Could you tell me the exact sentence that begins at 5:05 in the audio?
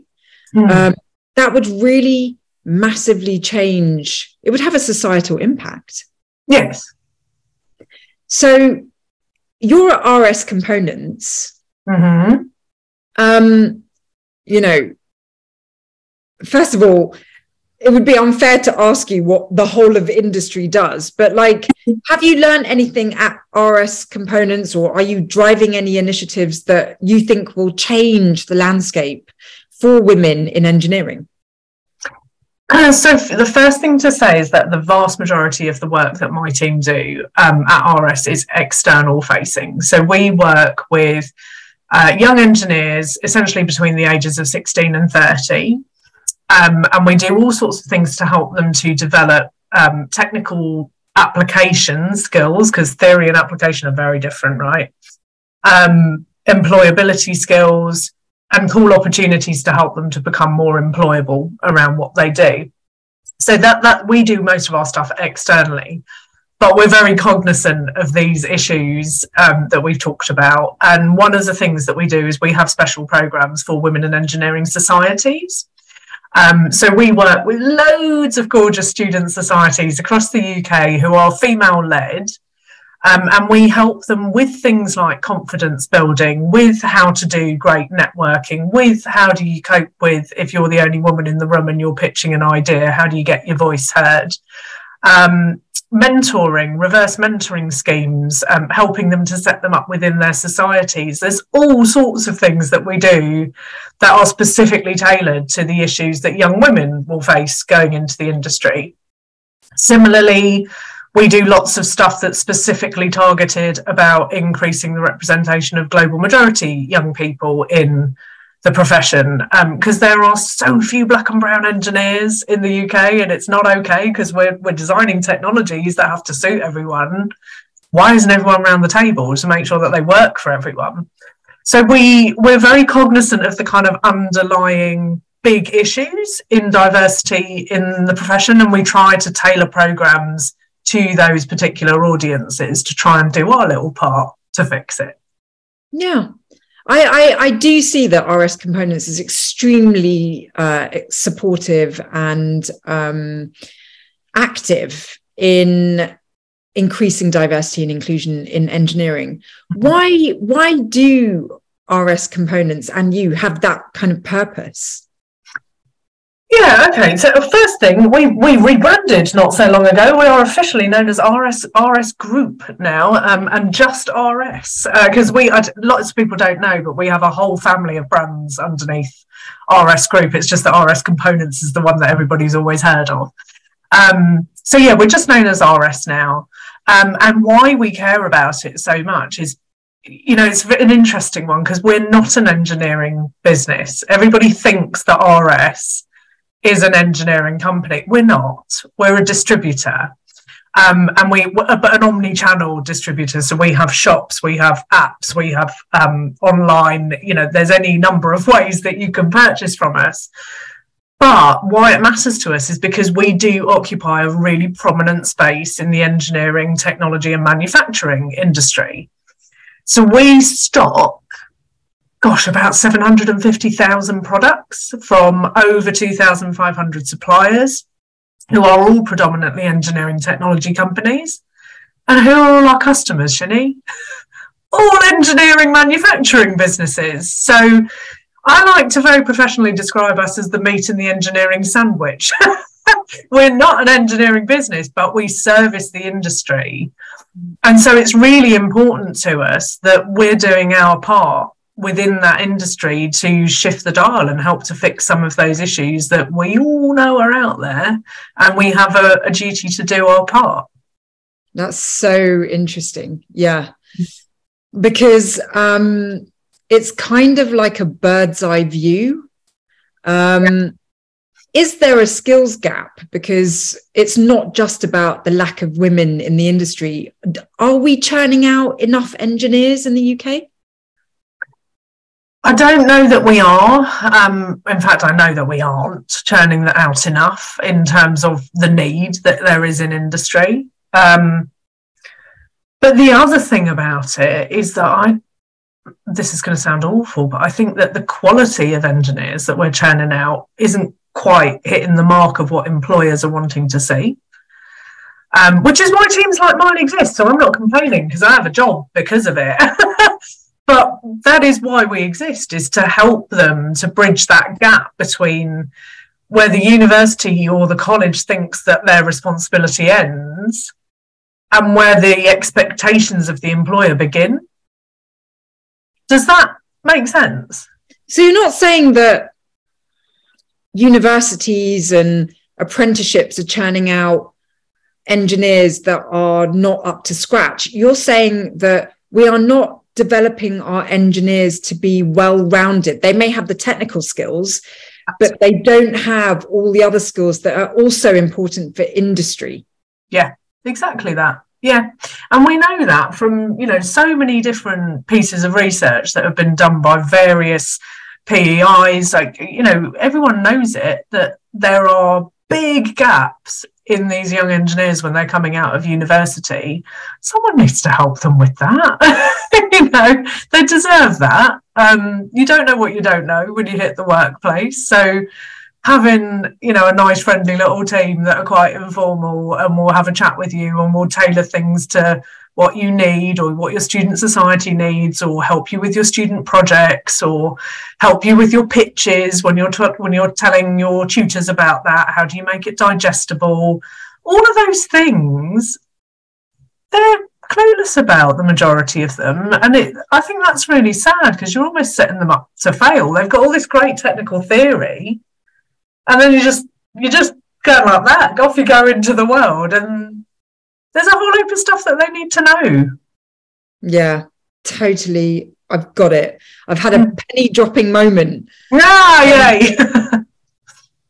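Um, which is why teams like mine exist.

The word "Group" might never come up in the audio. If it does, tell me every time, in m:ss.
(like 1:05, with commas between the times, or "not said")
2:52, 3:00.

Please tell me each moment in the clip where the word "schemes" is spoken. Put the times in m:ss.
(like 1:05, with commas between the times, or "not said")
1:37.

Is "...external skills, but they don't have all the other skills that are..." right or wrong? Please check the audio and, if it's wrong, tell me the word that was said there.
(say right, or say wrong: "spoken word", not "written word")
wrong: "technical", not "external".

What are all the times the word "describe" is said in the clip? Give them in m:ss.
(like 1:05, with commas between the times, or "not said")
3:59.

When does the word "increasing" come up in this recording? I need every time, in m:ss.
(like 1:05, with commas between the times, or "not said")
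1:54, 2:36.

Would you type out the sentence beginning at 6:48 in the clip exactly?
Off you go into the world, and there's a whole heap of stuff that they need to know.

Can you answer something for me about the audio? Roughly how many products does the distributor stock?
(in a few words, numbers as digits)
750,000.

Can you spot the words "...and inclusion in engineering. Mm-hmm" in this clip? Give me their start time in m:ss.
2:37.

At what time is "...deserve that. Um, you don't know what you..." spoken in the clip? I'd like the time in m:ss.
6:10.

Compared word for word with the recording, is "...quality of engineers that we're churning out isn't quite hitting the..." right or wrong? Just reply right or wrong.
right.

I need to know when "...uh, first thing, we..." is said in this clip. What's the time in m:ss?
2:47.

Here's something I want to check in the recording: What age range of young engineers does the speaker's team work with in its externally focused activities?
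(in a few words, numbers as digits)
16 to 30.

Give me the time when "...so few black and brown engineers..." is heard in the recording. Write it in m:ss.
2:00.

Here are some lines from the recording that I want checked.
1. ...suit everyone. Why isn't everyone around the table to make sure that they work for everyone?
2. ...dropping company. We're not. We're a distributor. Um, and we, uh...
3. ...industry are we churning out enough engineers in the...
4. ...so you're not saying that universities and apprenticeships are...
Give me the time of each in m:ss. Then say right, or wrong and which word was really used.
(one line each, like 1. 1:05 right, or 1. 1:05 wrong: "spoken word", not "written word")
1. 2:06 right
2. 3:16 wrong: "engineering", not "dropping"
3. 4:36 right
4. 5:28 right.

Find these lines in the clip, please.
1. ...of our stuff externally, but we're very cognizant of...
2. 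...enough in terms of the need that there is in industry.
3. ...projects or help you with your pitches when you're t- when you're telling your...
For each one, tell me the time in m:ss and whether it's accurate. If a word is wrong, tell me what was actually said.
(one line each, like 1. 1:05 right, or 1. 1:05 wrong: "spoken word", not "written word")
1. 1:04 right
2. 4:47 right
3. 6:26 right.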